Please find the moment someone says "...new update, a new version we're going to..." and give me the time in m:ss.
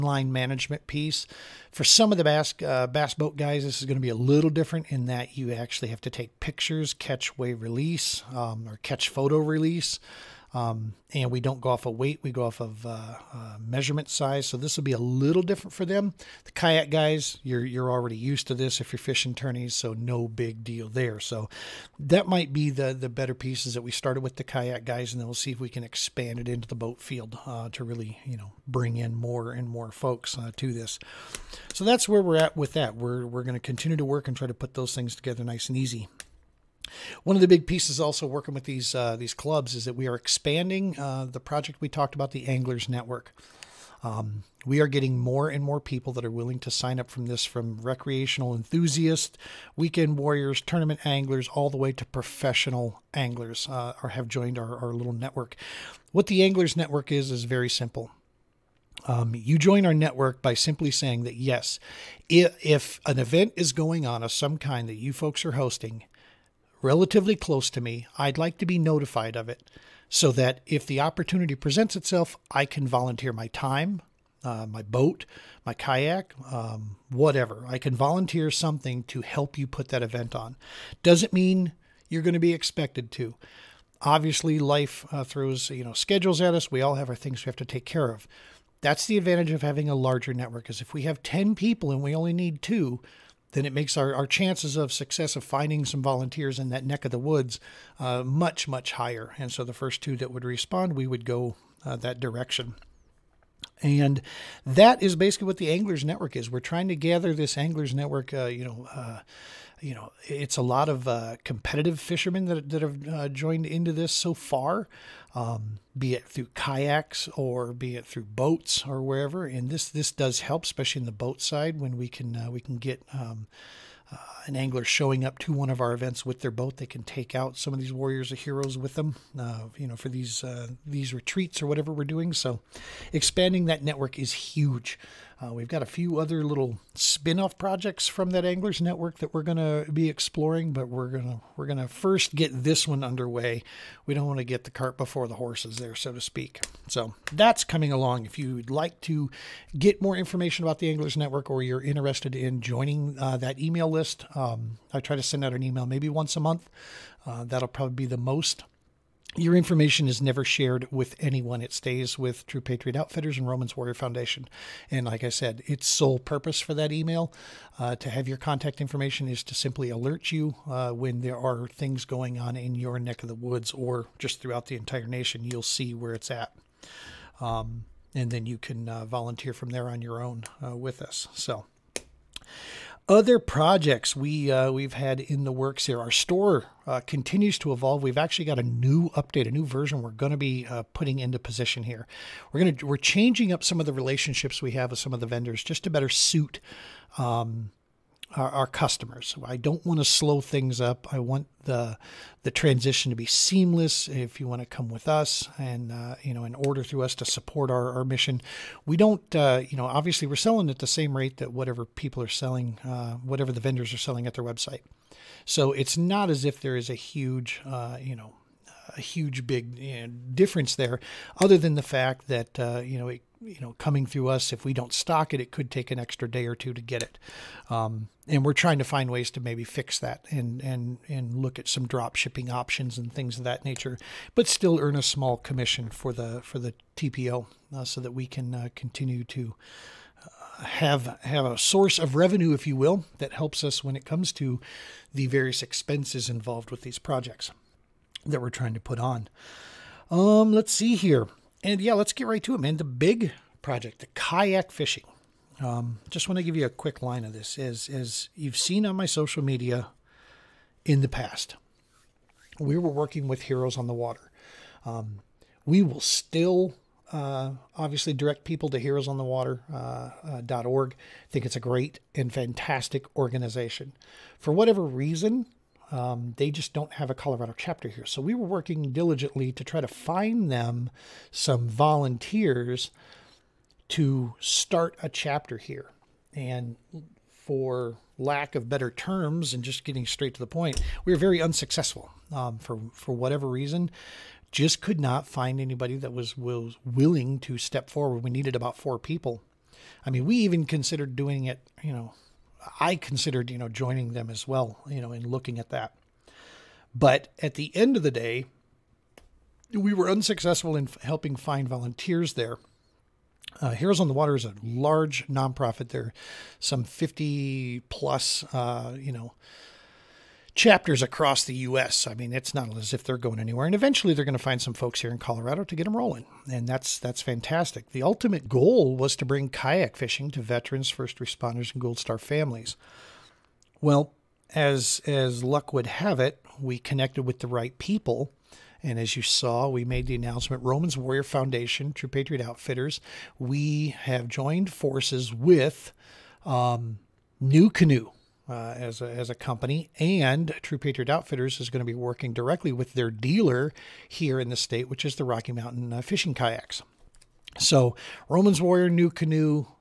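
3:08.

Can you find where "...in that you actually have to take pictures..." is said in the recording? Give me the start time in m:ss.
0:04.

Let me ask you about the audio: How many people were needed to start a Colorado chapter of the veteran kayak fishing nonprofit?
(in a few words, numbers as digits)
4.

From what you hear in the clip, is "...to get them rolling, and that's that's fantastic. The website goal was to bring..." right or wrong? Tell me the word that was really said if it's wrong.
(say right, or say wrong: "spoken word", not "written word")
wrong: "ultimate", not "website".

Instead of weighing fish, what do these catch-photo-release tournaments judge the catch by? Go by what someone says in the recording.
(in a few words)
Measurement size.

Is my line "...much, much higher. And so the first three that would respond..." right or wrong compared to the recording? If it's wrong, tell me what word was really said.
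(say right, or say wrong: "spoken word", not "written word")
wrong: "two", not "three".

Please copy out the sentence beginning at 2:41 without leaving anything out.
It stays with True Patriot Outfitters and Romans Warrior Foundation.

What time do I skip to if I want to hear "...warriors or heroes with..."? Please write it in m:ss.
2:07.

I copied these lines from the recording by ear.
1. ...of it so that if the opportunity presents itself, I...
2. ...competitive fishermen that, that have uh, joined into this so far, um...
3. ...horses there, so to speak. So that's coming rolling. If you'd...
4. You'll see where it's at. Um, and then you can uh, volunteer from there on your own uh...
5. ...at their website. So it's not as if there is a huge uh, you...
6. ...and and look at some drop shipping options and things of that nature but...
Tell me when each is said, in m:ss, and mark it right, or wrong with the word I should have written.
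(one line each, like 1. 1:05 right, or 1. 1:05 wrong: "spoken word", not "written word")
1. 1:09 right
2. 1:51 right
3. 2:25 wrong: "along", not "rolling"
4. 2:55 right
5. 3:34 right
6. 3:50 right.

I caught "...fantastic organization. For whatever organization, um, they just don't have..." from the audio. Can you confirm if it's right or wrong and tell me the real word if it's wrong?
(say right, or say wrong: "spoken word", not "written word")
wrong: "reason", not "organization".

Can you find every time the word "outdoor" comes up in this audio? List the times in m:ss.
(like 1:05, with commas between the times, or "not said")
not said.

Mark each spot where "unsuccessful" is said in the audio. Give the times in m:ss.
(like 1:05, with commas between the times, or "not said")
4:51, 5:10.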